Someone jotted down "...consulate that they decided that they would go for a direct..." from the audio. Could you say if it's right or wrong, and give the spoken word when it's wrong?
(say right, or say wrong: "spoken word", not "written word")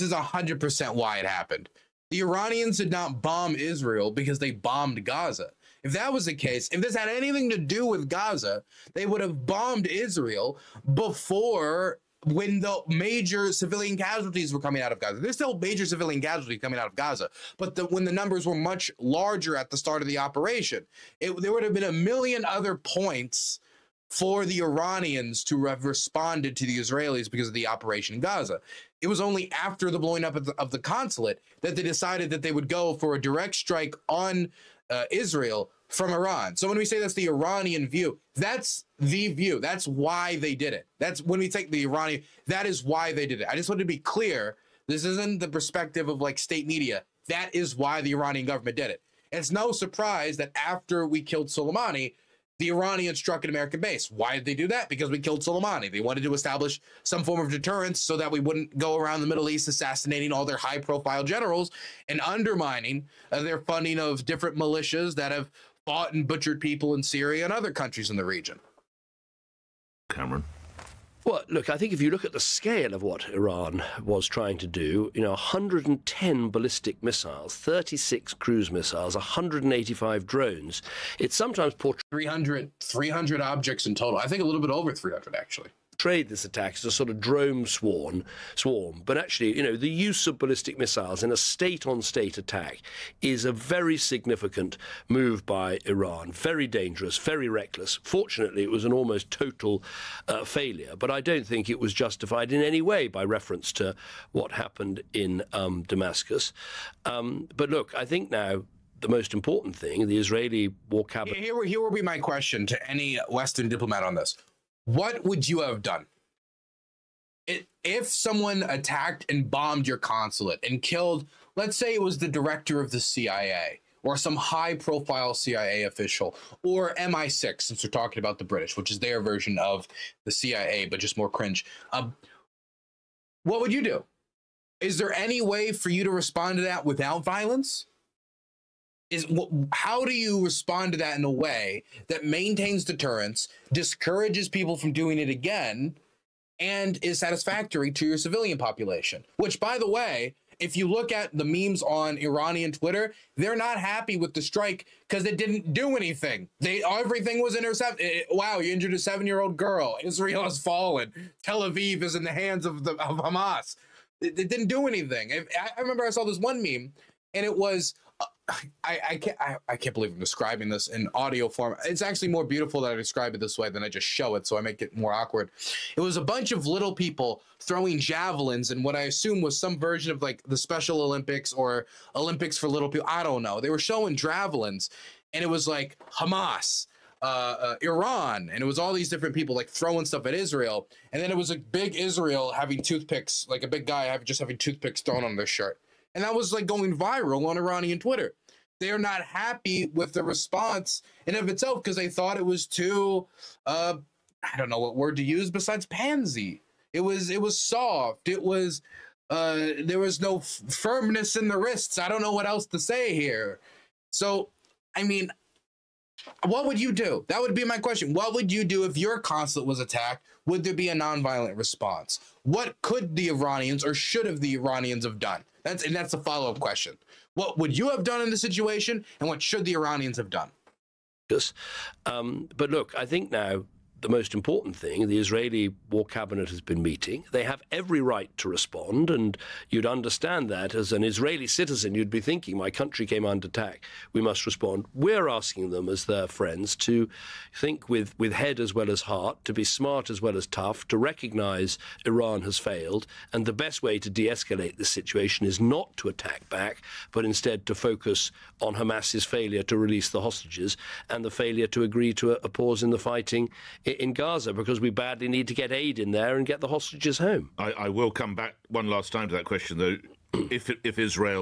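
right.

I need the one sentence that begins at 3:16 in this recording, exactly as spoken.
And that was like going viral on Iranian Twitter.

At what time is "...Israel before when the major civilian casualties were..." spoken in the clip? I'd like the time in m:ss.
0:09.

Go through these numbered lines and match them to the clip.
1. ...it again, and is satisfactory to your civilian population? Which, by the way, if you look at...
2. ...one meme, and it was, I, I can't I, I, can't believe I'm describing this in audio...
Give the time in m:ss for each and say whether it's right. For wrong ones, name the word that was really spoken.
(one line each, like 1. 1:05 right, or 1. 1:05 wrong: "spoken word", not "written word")
1. 2:25 right
2. 2:46 right.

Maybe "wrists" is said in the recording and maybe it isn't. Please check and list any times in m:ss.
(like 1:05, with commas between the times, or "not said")
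3:31.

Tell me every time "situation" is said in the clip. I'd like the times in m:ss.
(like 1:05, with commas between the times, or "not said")
3:48, 4:14.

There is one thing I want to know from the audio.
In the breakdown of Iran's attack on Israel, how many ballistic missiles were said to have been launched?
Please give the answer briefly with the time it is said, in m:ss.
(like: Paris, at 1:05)
110, at 1:15.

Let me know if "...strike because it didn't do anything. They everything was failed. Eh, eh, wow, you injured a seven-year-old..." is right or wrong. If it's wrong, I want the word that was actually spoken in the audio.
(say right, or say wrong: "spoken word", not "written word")
wrong: "intercepted", not "failed".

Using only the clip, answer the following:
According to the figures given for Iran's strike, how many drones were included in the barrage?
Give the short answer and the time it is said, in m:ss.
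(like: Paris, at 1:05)
185, at 1:19.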